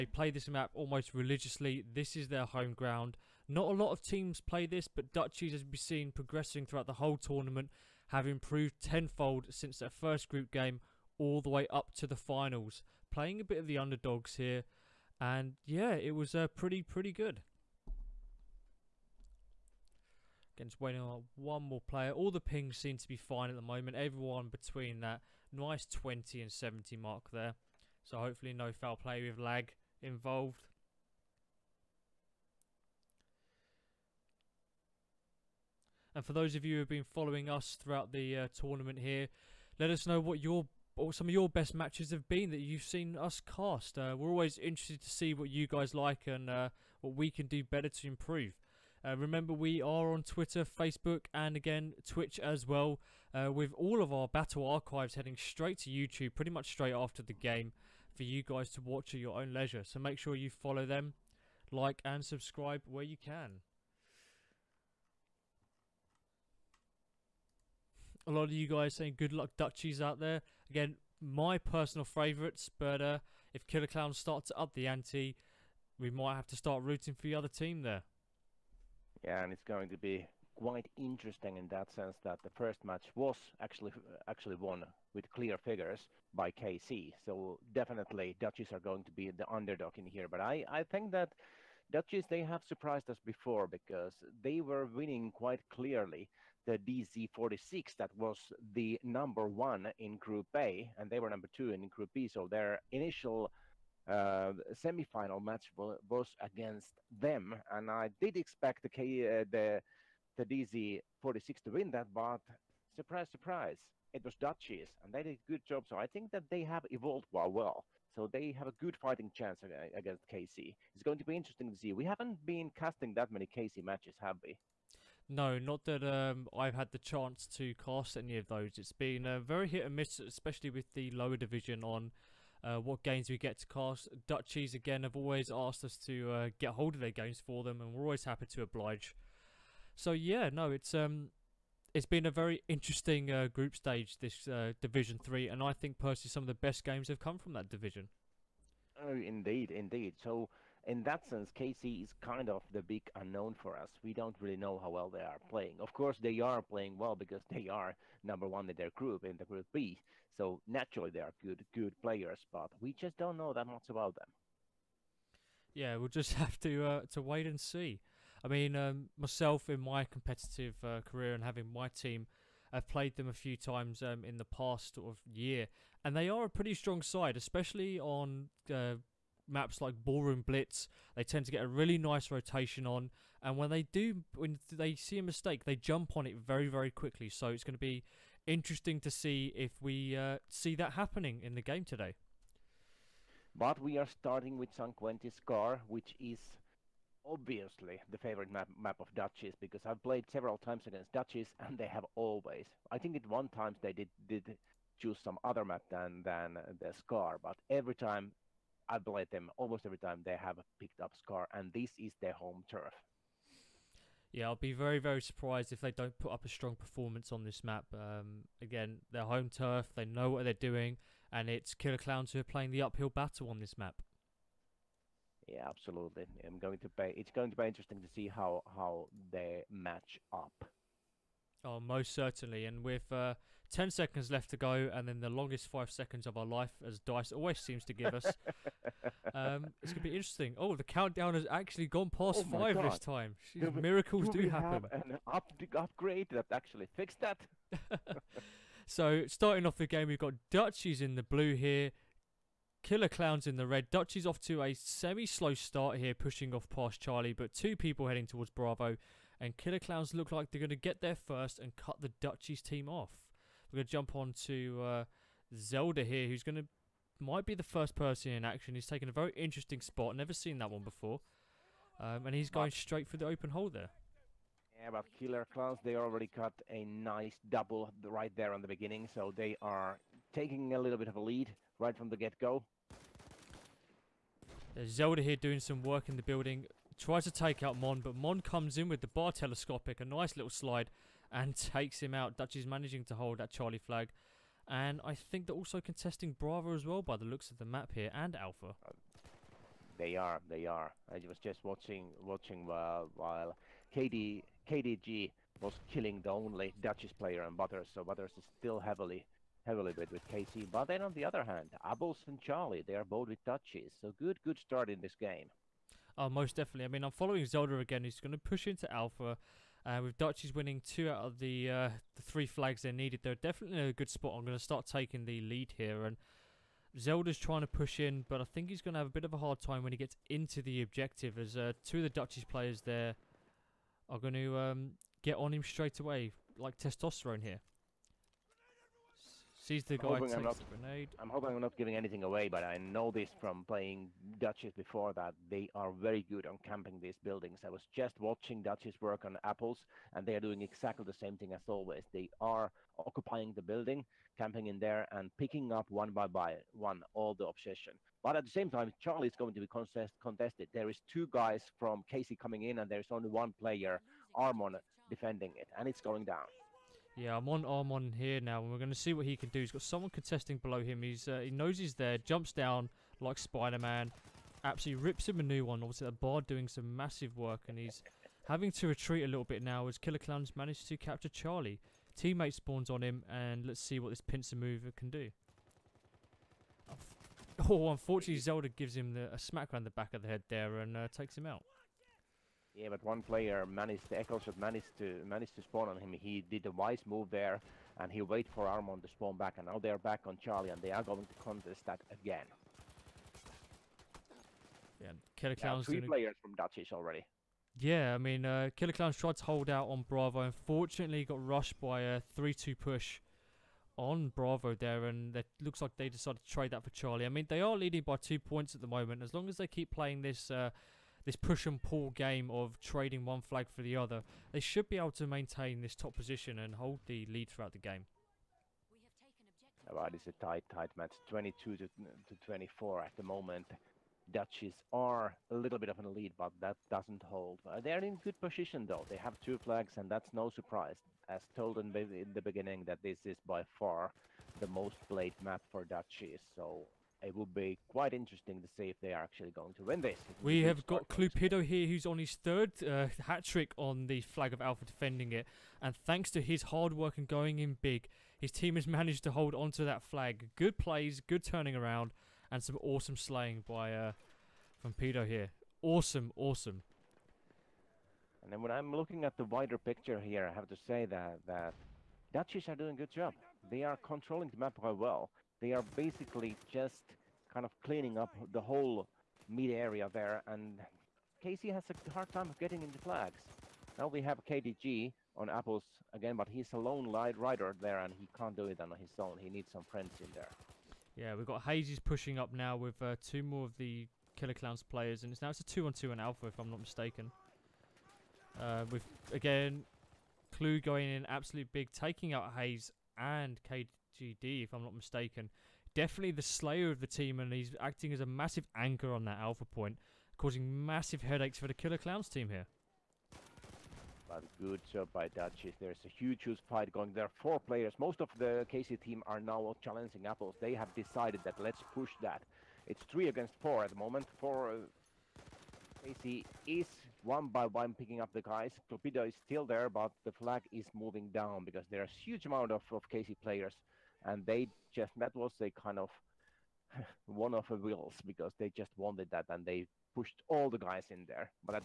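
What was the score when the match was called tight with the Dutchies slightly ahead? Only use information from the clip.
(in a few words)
22 to 24.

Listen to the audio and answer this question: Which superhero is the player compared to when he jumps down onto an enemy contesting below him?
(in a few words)
Spider-Man.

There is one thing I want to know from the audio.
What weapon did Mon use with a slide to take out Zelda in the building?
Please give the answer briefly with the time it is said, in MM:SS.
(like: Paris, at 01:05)
BAR telescopic, at 04:49.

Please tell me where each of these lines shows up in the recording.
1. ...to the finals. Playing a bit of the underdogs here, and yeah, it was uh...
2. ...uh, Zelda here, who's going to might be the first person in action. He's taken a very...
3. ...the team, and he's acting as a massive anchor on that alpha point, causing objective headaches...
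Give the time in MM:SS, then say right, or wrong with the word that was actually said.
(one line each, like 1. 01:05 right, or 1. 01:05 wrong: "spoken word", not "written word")
1. 00:11 right
2. 04:24 right
3. 08:26 wrong: "massive", not "objective".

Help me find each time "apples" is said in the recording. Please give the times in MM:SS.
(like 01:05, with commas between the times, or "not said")
05:11, 05:49, 08:05, 08:40.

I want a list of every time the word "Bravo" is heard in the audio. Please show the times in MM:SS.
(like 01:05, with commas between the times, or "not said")
04:18, 04:56, 06:50, 06:54.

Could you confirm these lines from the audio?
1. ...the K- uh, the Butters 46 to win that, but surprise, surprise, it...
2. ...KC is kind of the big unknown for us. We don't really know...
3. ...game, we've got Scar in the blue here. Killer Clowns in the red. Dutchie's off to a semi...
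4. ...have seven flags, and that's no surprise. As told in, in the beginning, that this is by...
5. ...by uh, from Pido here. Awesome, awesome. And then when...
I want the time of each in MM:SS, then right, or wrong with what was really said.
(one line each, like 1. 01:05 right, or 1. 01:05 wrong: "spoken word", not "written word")
1. 01:48 wrong: "Tedizzi", not "Butters"
2. 02:31 right
3. 04:09 wrong: "Dutchies", not "Scar"
4. 07:19 wrong: "two", not "seven"
5. 07:43 right.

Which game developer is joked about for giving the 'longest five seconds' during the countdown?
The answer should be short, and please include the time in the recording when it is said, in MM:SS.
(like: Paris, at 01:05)
Dice, at 03:56.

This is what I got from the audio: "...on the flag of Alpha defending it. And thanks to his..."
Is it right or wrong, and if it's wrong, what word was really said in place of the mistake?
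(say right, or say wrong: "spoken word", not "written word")
right.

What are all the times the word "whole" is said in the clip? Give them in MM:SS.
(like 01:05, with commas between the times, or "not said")
00:06, 07:58.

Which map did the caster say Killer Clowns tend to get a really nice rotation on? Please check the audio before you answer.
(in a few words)
Ballroom Blitz.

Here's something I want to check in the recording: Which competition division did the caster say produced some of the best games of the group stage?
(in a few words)
Division 3.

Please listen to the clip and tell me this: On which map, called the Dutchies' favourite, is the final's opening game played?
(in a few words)
San Quentin Scar.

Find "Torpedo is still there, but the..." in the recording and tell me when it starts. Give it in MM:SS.
08:48.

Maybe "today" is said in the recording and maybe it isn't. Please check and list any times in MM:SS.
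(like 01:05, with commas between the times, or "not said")
03:11.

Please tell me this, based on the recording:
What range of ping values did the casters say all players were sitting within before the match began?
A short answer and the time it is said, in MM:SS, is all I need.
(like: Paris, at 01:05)
20 to 70, at 00:25.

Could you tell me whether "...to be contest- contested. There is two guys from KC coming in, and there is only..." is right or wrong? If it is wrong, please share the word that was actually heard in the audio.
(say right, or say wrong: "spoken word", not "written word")
right.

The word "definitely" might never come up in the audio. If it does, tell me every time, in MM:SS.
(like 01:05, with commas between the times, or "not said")
01:27, 05:16, 05:23, 08:25.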